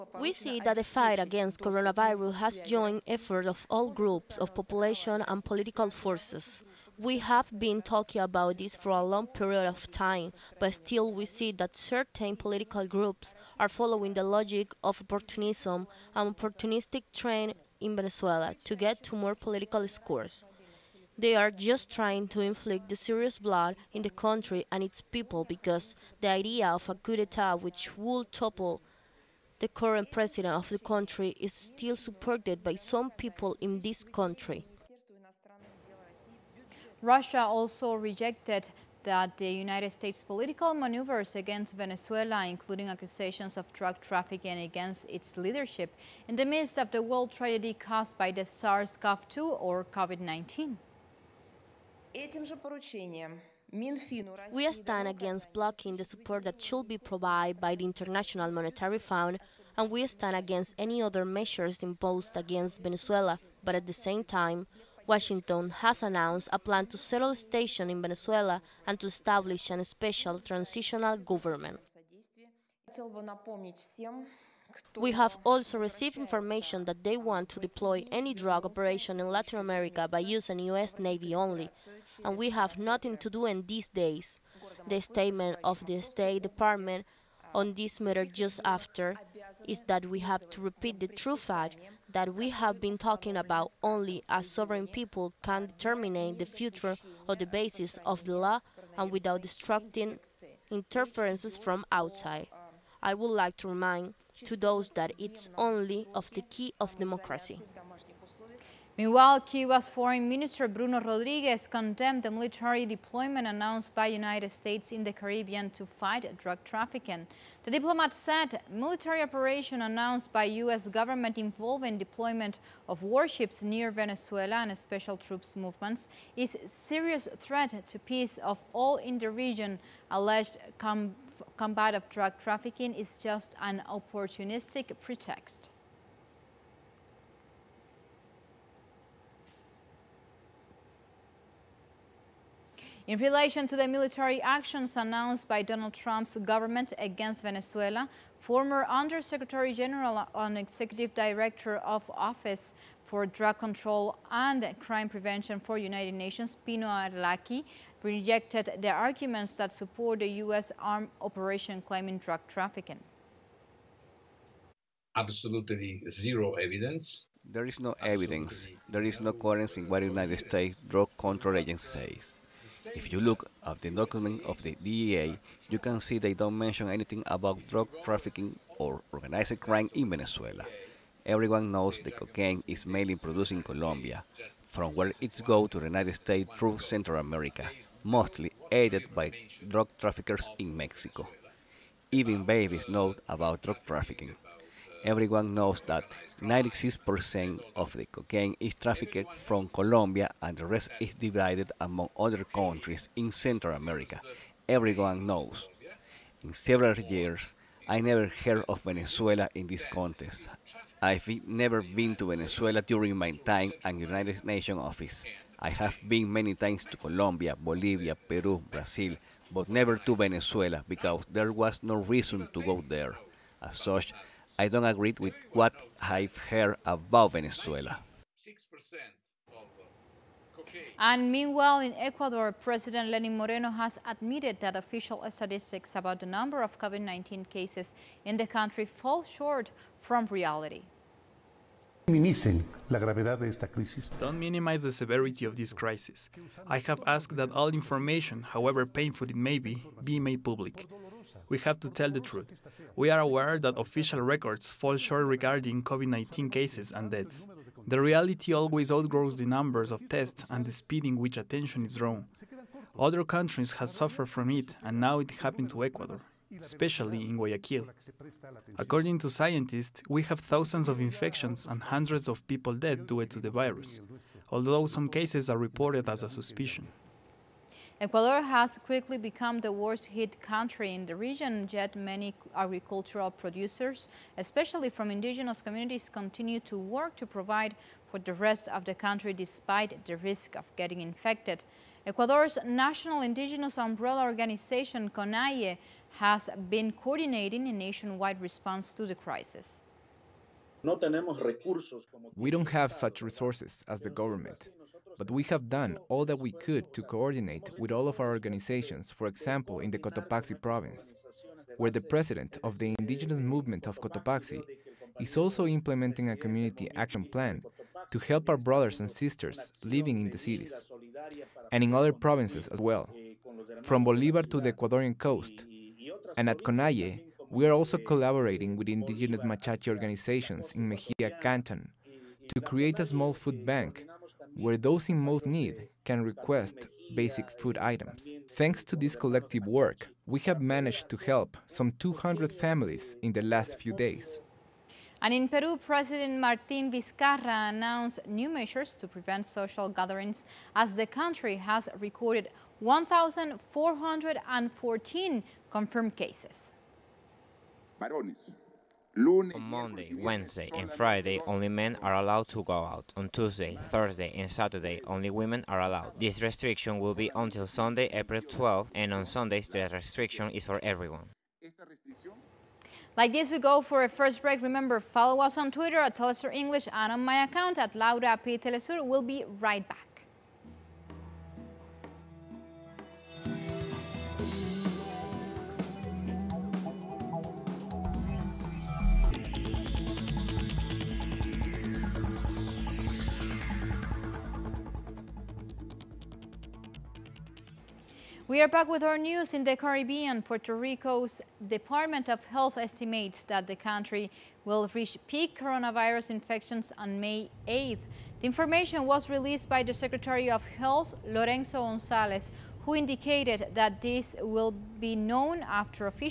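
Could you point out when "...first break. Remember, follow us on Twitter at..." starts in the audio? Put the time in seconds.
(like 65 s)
374 s.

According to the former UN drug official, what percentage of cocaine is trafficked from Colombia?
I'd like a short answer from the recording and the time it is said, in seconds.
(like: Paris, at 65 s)
96%, at 196 s.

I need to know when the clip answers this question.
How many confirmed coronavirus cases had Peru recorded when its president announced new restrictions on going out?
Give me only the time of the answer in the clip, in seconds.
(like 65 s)
352 s.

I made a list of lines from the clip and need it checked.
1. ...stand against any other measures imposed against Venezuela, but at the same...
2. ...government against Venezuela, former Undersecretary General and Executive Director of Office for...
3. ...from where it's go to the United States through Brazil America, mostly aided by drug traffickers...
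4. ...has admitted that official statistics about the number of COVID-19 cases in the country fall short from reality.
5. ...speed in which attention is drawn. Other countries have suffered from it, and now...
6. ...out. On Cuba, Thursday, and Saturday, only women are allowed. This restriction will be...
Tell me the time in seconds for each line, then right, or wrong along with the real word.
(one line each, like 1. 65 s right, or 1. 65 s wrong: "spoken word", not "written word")
1. 60 s right
2. 146 s right
3. 184 s wrong: "Central", not "Brazil"
4. 233 s right
5. 260 s right
6. 362 s wrong: "Tuesday", not "Cuba".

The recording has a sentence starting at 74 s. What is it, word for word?
We have also received information that they want to deploy any drug operation in Latin America by using U.S.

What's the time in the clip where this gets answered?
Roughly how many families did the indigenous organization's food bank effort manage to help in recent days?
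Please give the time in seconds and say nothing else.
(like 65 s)
341 s.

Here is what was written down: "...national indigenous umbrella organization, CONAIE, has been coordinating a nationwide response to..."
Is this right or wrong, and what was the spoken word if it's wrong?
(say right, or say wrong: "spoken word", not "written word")
right.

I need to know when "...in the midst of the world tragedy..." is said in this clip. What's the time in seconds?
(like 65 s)
46 s.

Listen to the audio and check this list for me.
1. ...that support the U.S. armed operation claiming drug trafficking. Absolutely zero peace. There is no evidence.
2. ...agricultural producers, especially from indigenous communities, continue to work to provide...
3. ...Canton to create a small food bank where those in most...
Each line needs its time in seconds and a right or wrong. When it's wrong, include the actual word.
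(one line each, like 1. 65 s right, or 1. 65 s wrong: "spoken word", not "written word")
1. 159 s wrong: "evidence", not "peace"
2. 282 s right
3. 331 s right.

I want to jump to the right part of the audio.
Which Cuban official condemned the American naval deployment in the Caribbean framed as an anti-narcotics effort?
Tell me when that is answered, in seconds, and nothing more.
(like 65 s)
110 s.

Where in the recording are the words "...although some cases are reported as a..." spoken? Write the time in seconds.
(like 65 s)
274 s.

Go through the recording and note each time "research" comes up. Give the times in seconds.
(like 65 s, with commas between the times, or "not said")
not said.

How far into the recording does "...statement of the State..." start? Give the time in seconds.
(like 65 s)
84 s.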